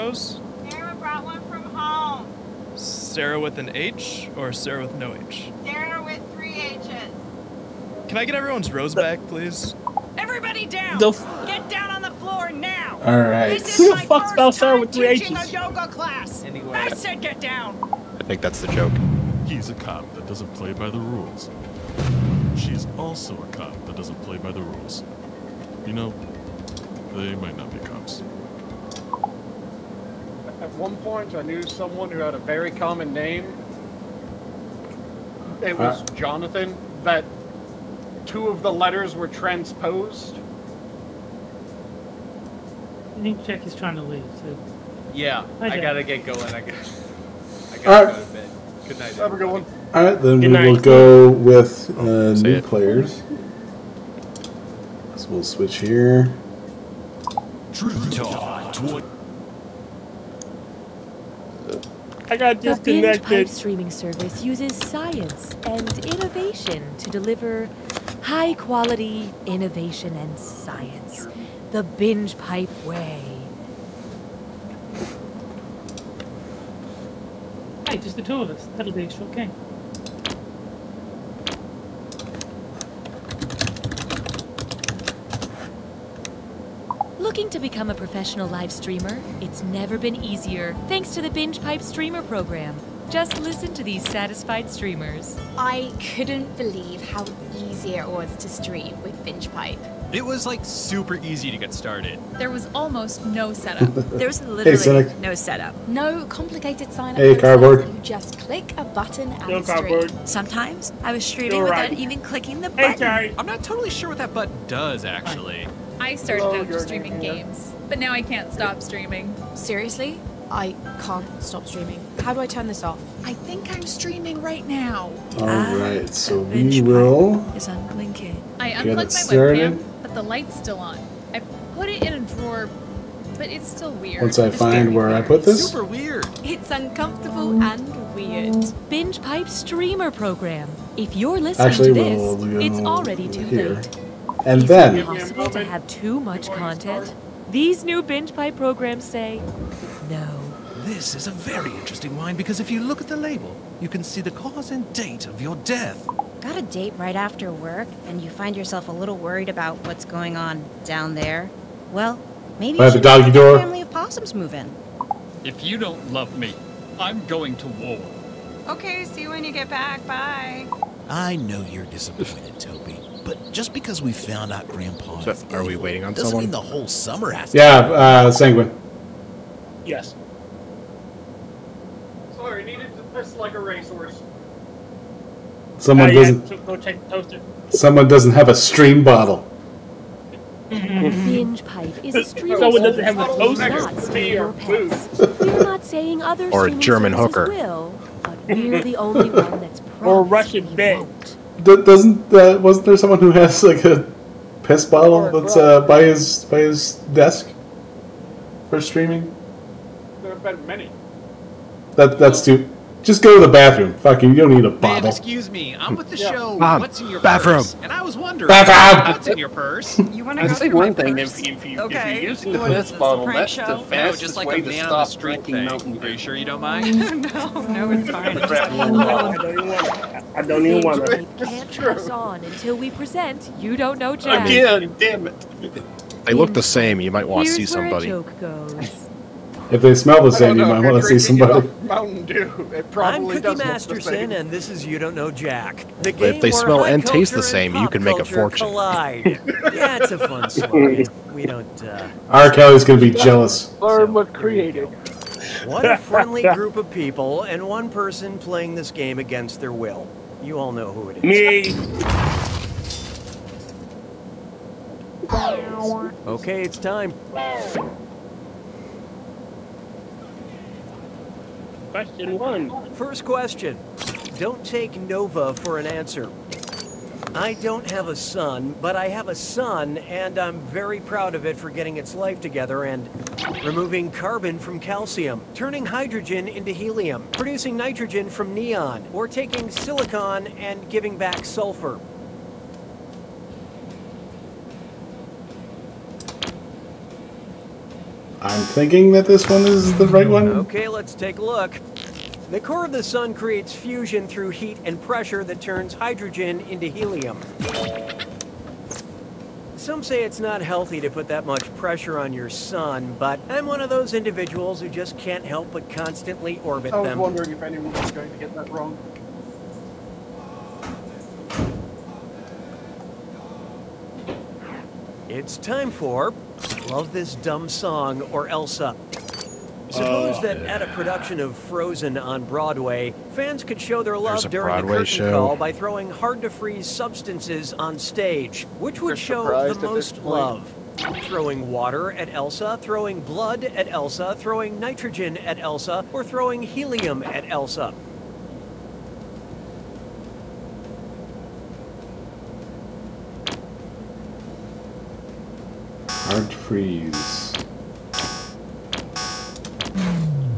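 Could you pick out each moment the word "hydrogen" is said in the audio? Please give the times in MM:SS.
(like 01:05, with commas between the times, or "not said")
04:45, 05:05.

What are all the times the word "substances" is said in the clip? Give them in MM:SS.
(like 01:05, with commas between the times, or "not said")
05:36.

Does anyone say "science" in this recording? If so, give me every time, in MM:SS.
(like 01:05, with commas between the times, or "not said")
01:04, 01:10.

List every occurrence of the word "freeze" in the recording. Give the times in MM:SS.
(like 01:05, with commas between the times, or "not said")
05:36, 05:56.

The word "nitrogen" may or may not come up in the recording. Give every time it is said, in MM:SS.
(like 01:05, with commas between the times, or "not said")
04:47, 05:44.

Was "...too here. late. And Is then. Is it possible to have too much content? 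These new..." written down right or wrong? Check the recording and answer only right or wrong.
right.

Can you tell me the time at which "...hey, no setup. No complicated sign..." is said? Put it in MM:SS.
01:45.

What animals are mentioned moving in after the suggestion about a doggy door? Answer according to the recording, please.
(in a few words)
possums.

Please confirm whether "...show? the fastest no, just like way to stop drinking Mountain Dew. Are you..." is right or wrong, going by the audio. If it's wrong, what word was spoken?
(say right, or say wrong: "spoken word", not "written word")
right.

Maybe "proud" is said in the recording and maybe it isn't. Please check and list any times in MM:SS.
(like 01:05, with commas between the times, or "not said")
04:41.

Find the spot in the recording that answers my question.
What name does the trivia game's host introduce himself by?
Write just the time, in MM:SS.
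04:03.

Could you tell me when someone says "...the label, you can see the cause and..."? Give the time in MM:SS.
02:33.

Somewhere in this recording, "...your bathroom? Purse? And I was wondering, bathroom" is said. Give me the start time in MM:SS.
03:37.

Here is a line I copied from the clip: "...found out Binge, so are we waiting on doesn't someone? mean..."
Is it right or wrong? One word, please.
wrong.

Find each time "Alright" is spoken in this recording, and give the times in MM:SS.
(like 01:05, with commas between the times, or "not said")
00:13, 00:49.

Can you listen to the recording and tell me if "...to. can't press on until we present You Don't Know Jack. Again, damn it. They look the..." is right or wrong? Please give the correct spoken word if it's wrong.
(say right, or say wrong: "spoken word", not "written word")
right.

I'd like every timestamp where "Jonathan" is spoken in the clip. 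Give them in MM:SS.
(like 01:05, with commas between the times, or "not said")
00:36.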